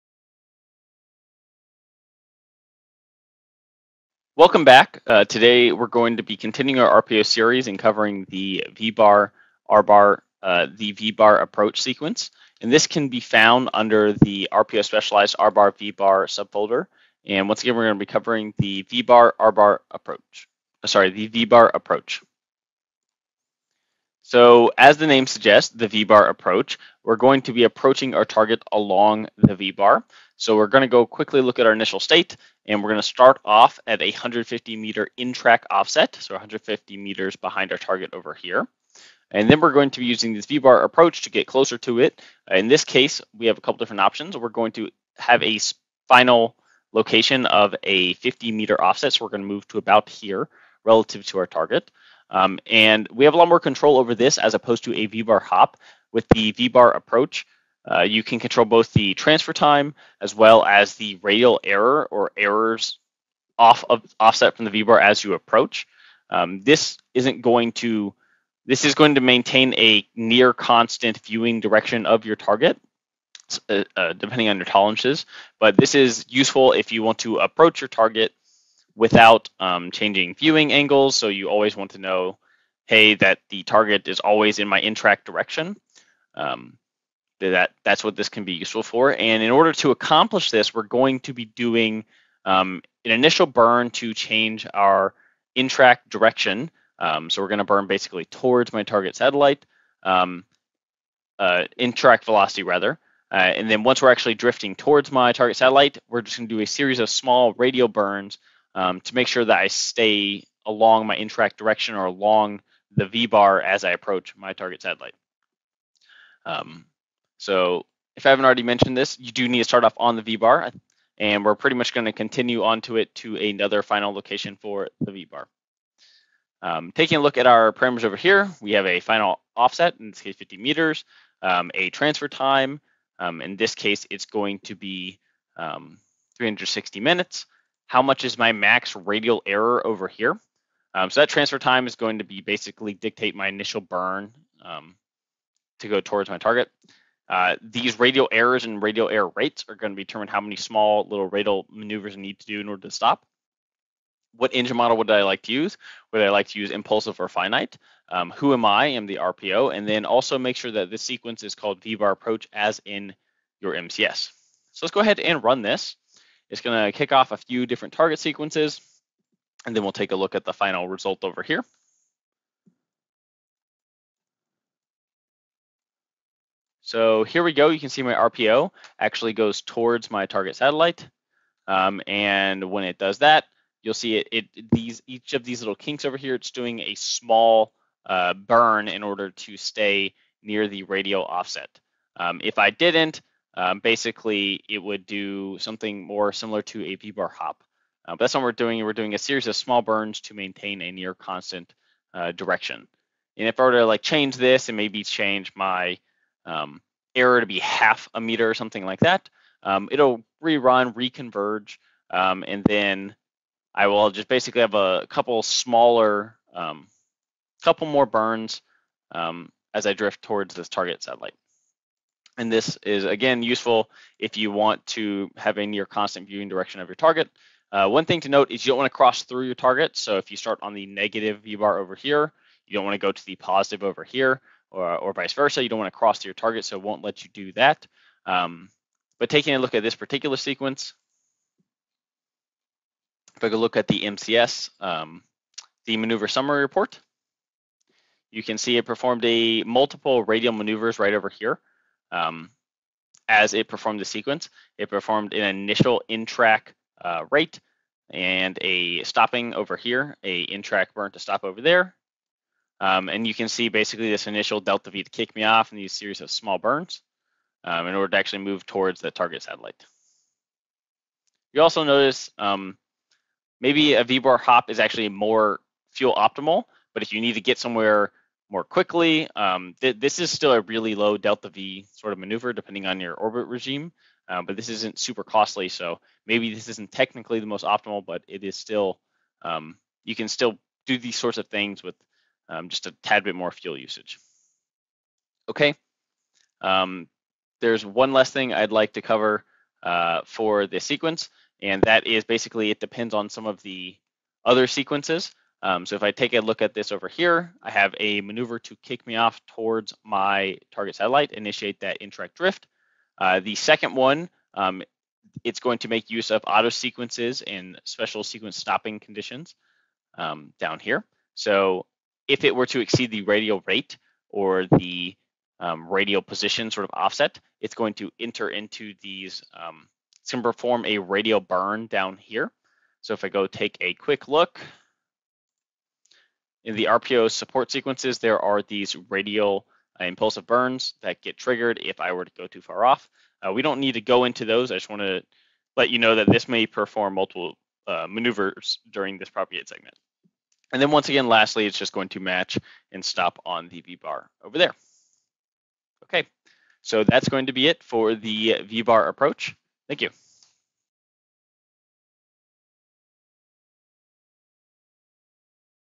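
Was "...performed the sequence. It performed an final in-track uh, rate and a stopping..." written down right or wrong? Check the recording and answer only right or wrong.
wrong.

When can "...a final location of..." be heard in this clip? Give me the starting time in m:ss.
0:45.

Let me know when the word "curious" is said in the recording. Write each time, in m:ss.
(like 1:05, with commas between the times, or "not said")
not said.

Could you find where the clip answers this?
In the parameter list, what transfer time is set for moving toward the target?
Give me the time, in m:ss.
2:16.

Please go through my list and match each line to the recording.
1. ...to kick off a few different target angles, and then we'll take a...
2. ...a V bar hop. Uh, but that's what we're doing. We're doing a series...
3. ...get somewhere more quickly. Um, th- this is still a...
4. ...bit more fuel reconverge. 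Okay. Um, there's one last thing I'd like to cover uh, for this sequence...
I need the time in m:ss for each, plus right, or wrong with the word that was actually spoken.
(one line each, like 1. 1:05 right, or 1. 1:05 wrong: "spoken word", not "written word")
1. 2:46 wrong: "sequences", not "angles"
2. 3:16 right
3. 4:37 right
4. 4:53 wrong: "usage", not "reconverge".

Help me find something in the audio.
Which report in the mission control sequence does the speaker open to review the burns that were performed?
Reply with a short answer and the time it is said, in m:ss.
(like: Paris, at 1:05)
maneuver summary report, at 4:05.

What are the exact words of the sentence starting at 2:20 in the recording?
Um, so that transfer time is going to be basically dictate my initial burn um, to go towards my target.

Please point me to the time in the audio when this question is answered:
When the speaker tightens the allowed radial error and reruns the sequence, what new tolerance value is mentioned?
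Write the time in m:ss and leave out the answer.
3:27.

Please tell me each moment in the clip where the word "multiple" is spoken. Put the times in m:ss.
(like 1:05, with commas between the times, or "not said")
4:09, 5:47.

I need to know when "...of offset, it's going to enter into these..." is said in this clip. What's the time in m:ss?
5:26.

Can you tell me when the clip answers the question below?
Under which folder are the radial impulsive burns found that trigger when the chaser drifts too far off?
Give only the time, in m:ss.
5:36.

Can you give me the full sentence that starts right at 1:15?
But this is useful if you want to approach your target without um, changing viewing angles.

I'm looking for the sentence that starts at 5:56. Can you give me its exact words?
Okay, so that's going to be it for the V-bar approach.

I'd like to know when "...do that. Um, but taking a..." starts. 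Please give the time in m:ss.
3:57.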